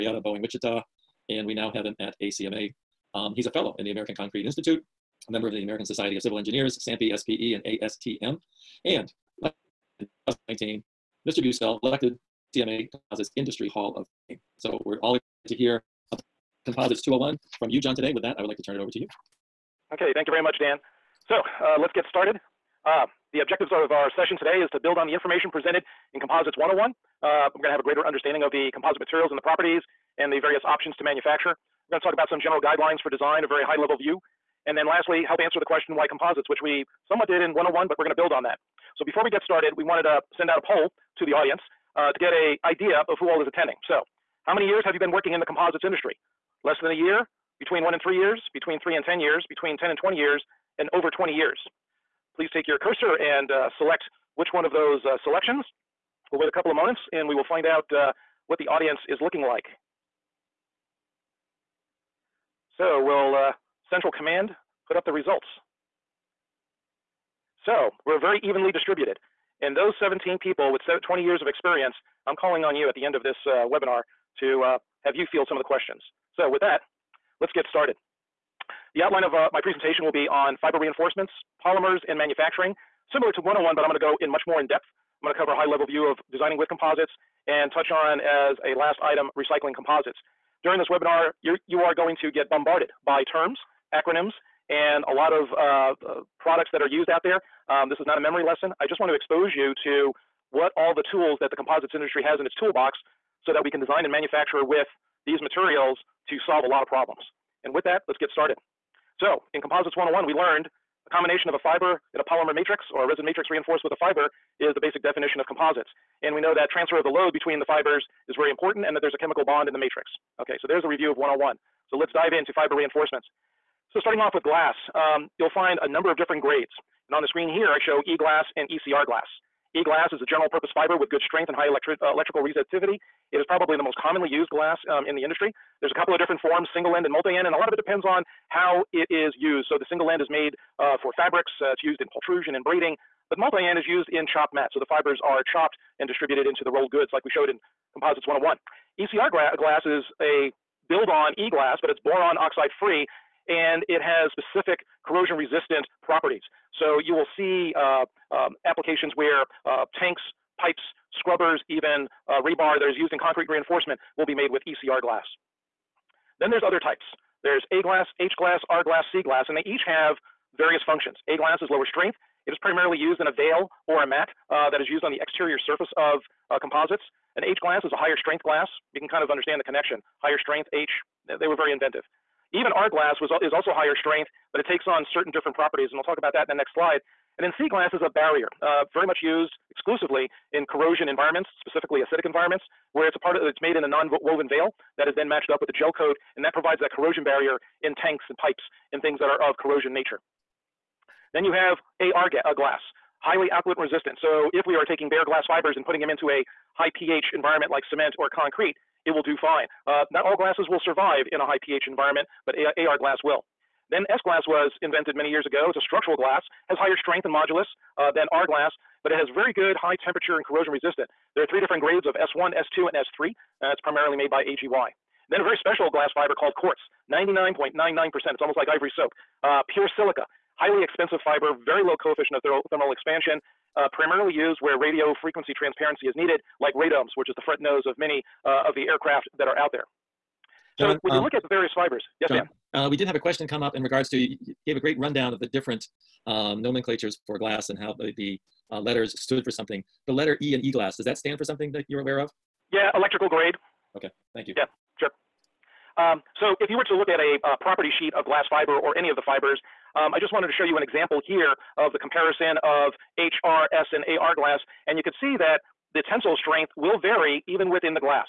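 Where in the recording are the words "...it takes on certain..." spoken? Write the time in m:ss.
3:04.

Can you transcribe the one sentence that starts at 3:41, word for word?
There are three different grades of S1, S2, and S3.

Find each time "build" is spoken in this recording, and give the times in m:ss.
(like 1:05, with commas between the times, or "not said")
0:24, 0:38, 2:30.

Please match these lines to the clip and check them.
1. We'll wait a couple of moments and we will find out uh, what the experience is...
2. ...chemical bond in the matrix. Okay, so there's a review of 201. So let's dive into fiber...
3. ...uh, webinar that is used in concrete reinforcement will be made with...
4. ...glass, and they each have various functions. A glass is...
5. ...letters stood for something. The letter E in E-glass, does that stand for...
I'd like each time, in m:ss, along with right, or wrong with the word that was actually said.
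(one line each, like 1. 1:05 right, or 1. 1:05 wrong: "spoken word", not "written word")
1. 0:56 wrong: "audience", not "experience"
2. 1:59 wrong: "101", not "201"
3. 2:42 wrong: "rebar", not "webinar"
4. 2:49 right
5. 4:08 right.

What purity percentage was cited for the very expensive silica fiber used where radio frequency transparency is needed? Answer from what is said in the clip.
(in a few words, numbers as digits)
99.99%.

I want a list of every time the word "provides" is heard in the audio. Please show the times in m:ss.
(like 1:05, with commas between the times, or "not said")
3:16.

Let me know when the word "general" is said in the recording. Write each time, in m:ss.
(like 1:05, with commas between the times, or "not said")
0:32, 2:10.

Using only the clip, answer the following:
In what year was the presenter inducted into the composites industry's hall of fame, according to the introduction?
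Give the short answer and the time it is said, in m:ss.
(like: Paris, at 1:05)
2019, at 0:09.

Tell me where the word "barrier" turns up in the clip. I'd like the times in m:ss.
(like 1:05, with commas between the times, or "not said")
3:08, 3:17.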